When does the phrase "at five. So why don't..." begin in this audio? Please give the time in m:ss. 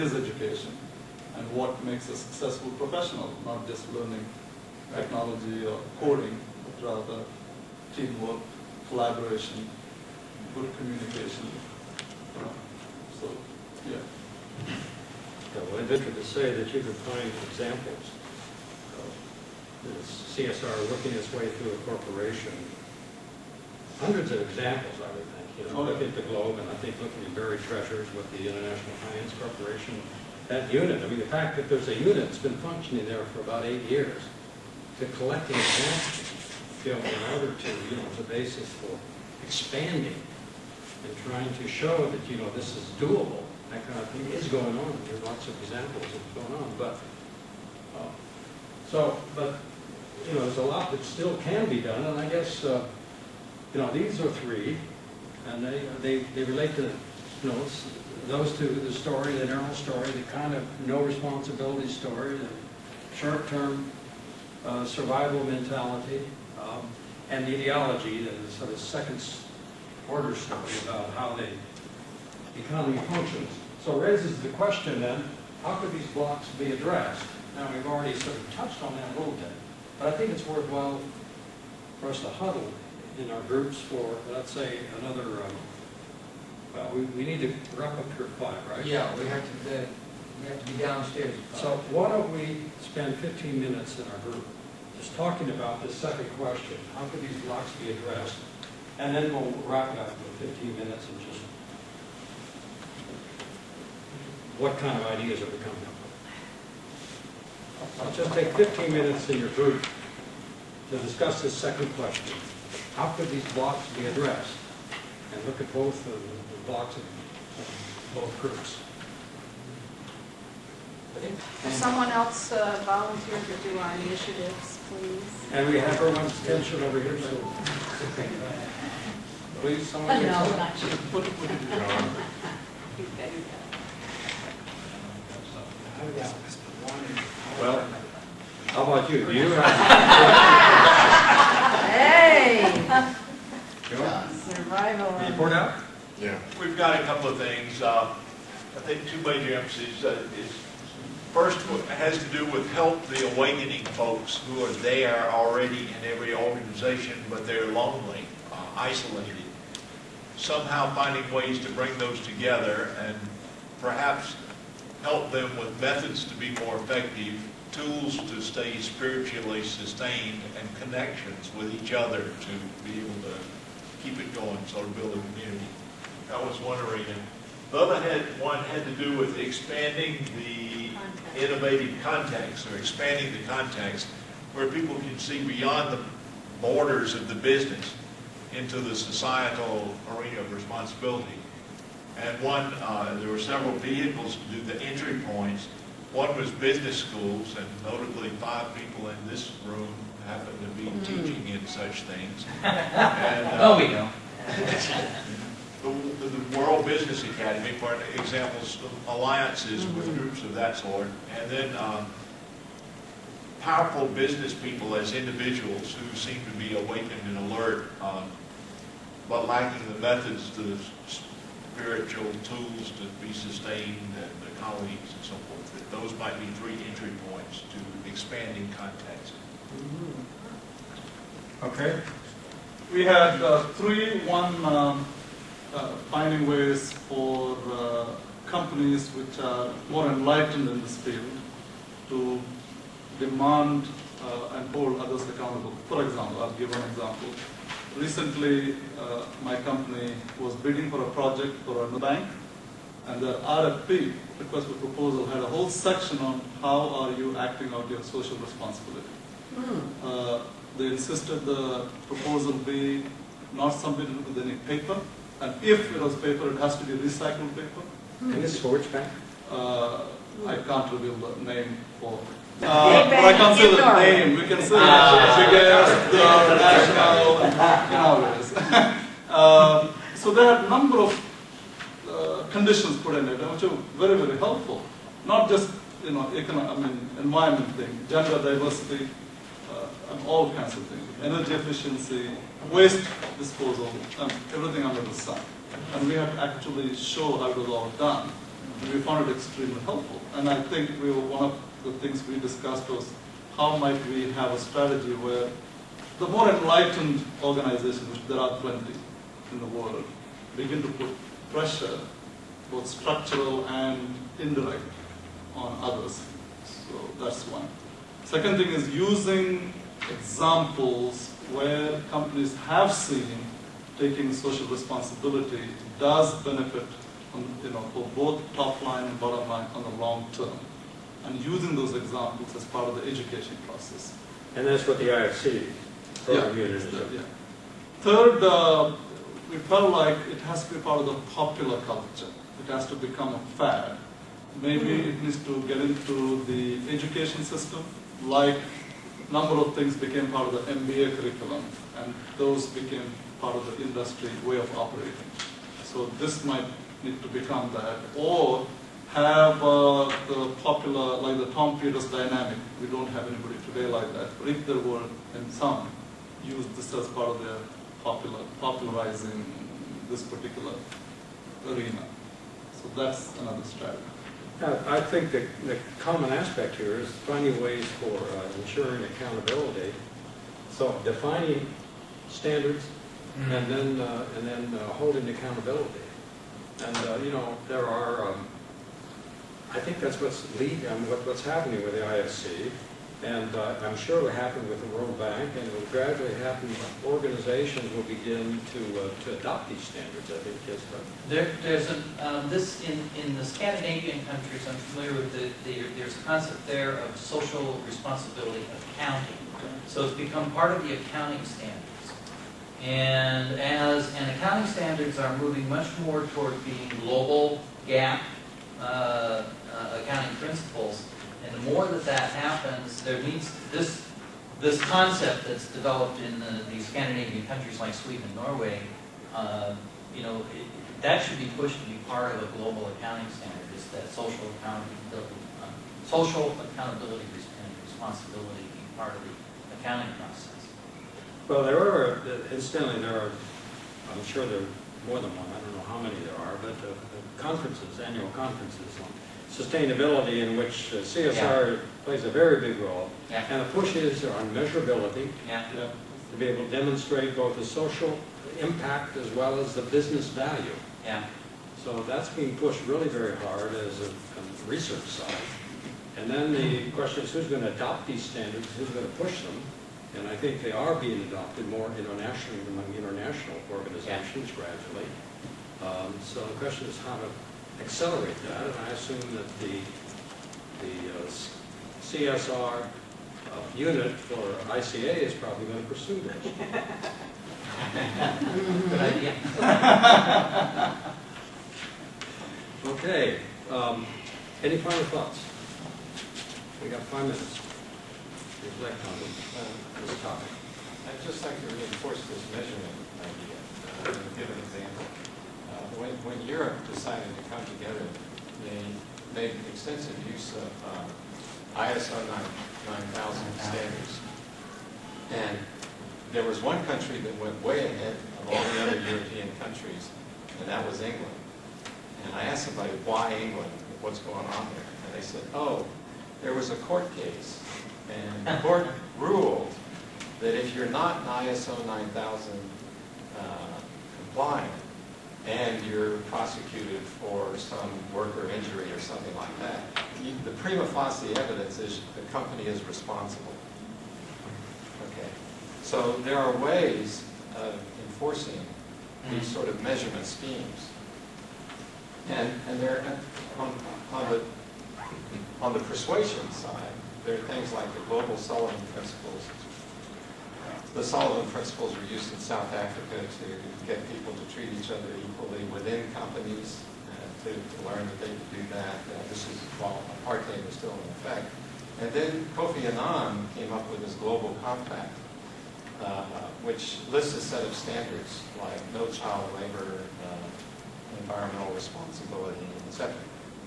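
1:31.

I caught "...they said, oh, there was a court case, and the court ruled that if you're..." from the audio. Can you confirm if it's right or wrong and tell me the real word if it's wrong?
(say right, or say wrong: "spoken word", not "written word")
right.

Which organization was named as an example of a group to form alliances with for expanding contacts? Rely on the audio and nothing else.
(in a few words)
World Business Academy.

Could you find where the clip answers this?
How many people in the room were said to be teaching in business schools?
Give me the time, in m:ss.
3:18.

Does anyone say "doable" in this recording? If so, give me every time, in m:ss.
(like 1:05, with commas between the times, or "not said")
0:42.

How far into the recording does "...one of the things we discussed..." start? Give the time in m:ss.
5:01.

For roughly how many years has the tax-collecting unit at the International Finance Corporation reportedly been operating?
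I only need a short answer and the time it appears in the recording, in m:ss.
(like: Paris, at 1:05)
8, at 0:33.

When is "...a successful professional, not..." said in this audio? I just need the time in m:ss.
0:02.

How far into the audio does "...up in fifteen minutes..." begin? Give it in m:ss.
1:39.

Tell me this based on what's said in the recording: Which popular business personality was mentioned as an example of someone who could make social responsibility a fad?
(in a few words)
Tom Peters.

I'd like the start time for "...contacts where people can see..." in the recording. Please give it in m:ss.
3:03.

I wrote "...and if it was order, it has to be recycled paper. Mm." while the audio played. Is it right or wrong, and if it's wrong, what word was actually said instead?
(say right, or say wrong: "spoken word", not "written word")
wrong: "paper", not "order".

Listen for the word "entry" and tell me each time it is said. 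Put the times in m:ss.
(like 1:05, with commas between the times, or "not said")
3:14, 3:46.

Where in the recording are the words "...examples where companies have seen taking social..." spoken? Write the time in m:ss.
5:20.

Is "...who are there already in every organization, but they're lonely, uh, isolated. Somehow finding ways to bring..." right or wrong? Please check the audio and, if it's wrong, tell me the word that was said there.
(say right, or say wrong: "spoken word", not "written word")
right.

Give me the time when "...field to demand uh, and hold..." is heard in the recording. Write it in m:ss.
4:00.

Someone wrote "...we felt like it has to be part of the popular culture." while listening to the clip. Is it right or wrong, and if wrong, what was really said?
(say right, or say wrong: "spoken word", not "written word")
right.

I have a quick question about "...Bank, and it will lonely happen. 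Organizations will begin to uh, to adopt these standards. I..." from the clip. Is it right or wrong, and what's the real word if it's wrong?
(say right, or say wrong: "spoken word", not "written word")
wrong: "gradually", not "lonely".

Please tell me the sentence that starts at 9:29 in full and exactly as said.
Uh, this is while apartheid was still in effect.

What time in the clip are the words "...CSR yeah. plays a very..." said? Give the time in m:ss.
7:30.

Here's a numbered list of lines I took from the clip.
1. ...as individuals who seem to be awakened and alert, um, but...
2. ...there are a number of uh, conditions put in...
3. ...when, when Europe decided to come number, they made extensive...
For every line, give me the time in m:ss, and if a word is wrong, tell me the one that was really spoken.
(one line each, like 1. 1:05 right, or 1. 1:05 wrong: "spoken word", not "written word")
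1. 3:35 right
2. 4:40 right
3. 8:25 wrong: "together", not "number".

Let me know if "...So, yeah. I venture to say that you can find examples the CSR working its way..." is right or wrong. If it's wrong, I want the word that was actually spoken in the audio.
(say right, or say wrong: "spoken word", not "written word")
right.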